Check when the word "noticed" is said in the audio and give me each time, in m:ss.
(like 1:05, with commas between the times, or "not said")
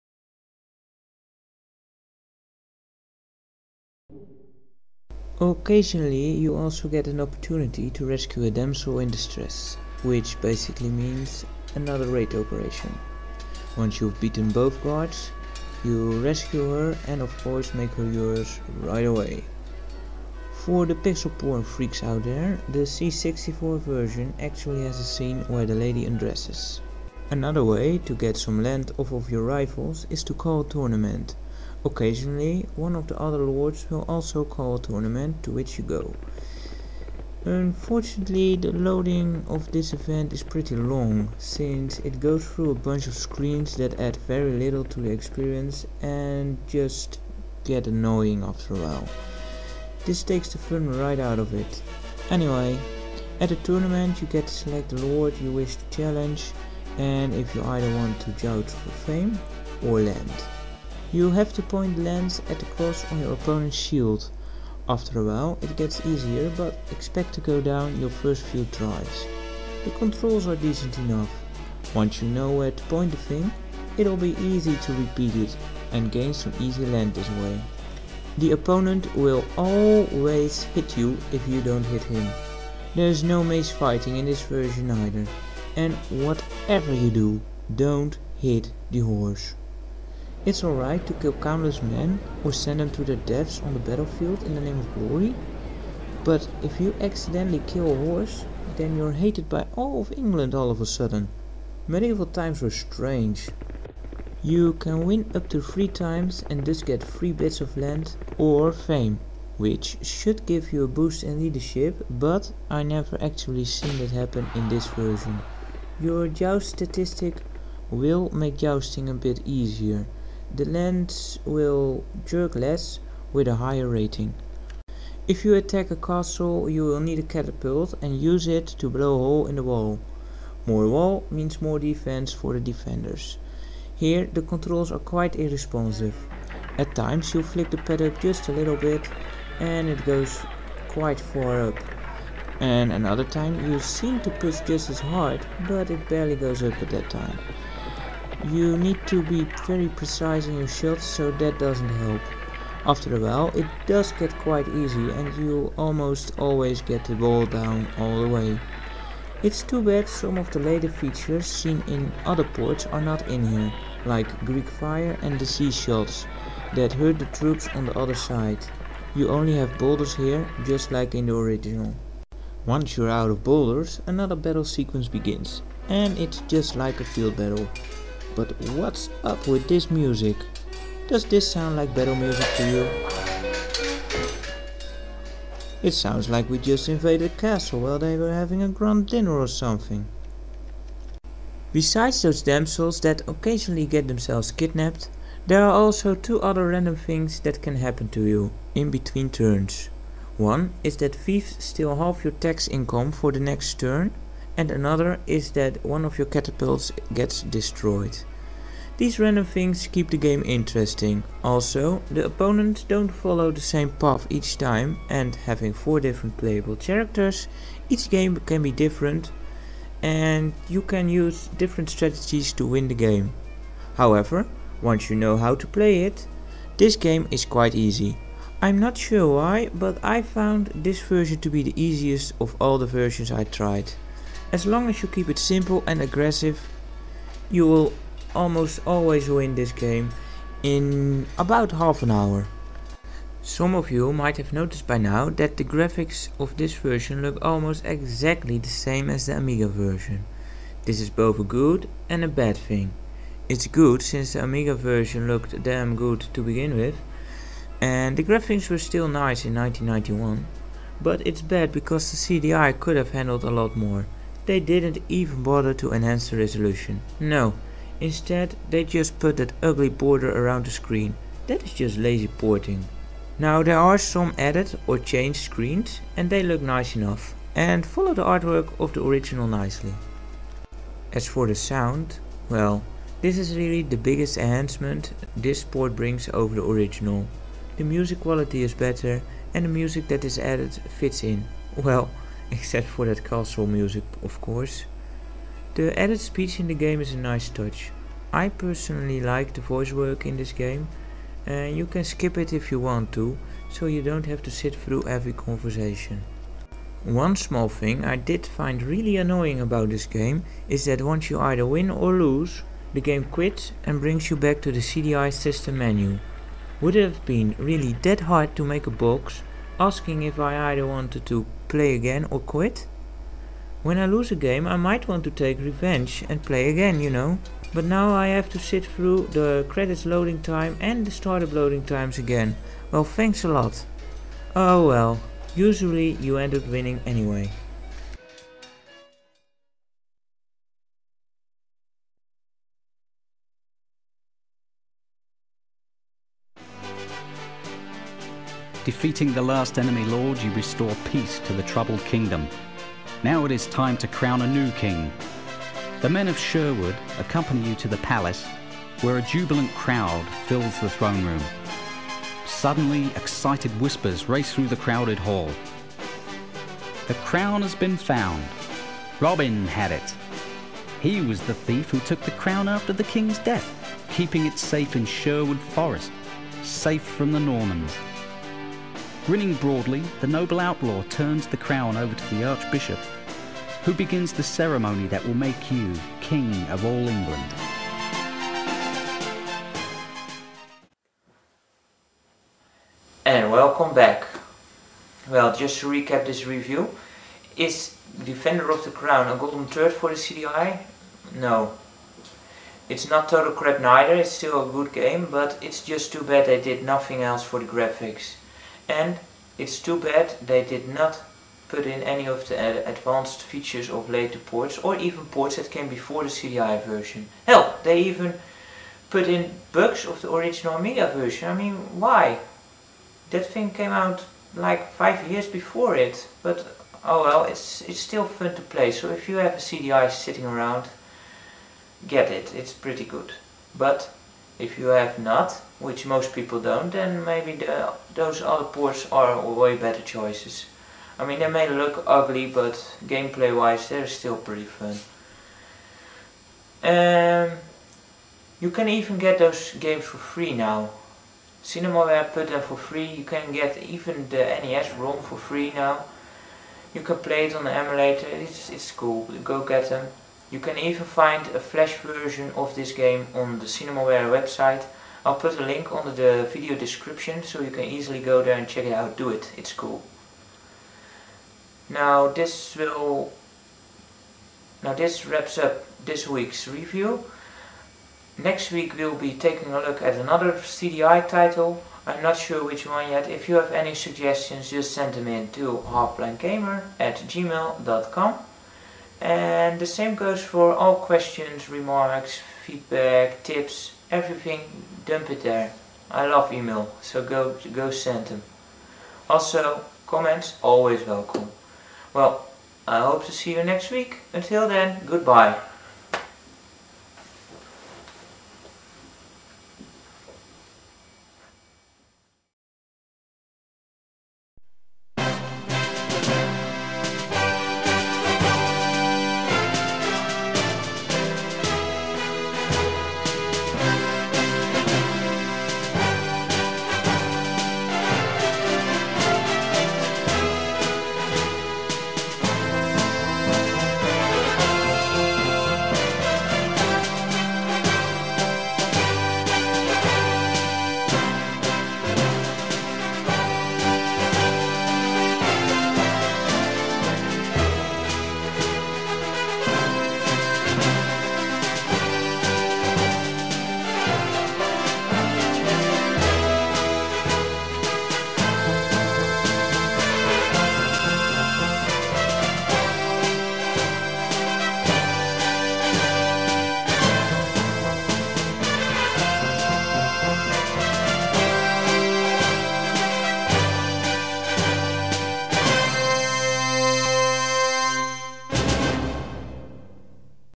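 4:04.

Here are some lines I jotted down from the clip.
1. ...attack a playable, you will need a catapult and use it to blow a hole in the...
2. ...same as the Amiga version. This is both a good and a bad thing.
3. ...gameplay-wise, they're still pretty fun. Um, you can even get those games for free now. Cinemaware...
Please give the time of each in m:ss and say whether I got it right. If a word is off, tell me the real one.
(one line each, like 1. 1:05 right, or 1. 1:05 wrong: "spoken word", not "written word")
1. 2:05 wrong: "castle", not "playable"
2. 4:08 right
3. 7:23 right.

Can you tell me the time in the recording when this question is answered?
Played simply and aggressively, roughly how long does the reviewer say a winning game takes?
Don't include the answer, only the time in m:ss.
4:01.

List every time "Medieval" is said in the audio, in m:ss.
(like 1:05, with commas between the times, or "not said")
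1:41.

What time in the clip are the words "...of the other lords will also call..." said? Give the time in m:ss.
0:32.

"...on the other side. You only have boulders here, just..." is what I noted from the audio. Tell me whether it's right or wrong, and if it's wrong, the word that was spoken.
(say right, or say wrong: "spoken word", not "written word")
right.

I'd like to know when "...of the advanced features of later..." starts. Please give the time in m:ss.
6:52.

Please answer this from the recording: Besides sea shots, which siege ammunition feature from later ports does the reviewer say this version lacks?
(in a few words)
Greek fire.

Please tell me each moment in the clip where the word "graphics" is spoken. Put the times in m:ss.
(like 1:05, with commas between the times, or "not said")
4:05, 4:18, 6:47.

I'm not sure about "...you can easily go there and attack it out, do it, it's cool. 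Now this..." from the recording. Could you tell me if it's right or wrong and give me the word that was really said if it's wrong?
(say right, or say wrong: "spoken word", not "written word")
wrong: "check", not "attack".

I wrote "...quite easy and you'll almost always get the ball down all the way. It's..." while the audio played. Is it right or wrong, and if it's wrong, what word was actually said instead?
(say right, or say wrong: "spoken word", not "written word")
right.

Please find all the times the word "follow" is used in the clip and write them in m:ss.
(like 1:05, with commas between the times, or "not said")
3:33, 4:37.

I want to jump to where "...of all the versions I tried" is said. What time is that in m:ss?
3:52.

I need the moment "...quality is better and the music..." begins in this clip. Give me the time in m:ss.
4:48.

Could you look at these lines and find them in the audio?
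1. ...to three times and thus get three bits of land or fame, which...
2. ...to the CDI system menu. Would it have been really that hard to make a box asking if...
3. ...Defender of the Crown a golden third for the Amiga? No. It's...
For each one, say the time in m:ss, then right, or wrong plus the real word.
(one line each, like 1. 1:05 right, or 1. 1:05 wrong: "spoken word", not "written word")
1. 1:45 right
2. 5:14 right
3. 6:38 wrong: "CDI", not "Amiga".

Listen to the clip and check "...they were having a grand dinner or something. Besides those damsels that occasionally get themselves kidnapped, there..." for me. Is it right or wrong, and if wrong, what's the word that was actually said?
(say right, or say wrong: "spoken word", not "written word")
right.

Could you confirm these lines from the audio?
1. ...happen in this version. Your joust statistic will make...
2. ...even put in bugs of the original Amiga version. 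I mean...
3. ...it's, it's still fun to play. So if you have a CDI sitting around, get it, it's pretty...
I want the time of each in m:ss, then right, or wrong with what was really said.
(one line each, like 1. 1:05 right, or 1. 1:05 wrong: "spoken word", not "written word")
1. 1:54 right
2. 6:58 right
3. 7:07 right.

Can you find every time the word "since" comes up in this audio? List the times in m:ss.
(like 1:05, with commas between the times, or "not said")
0:41, 4:14.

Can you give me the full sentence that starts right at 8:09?
And the same goes for all questions, remarks, feedback, tips, everything dump it there.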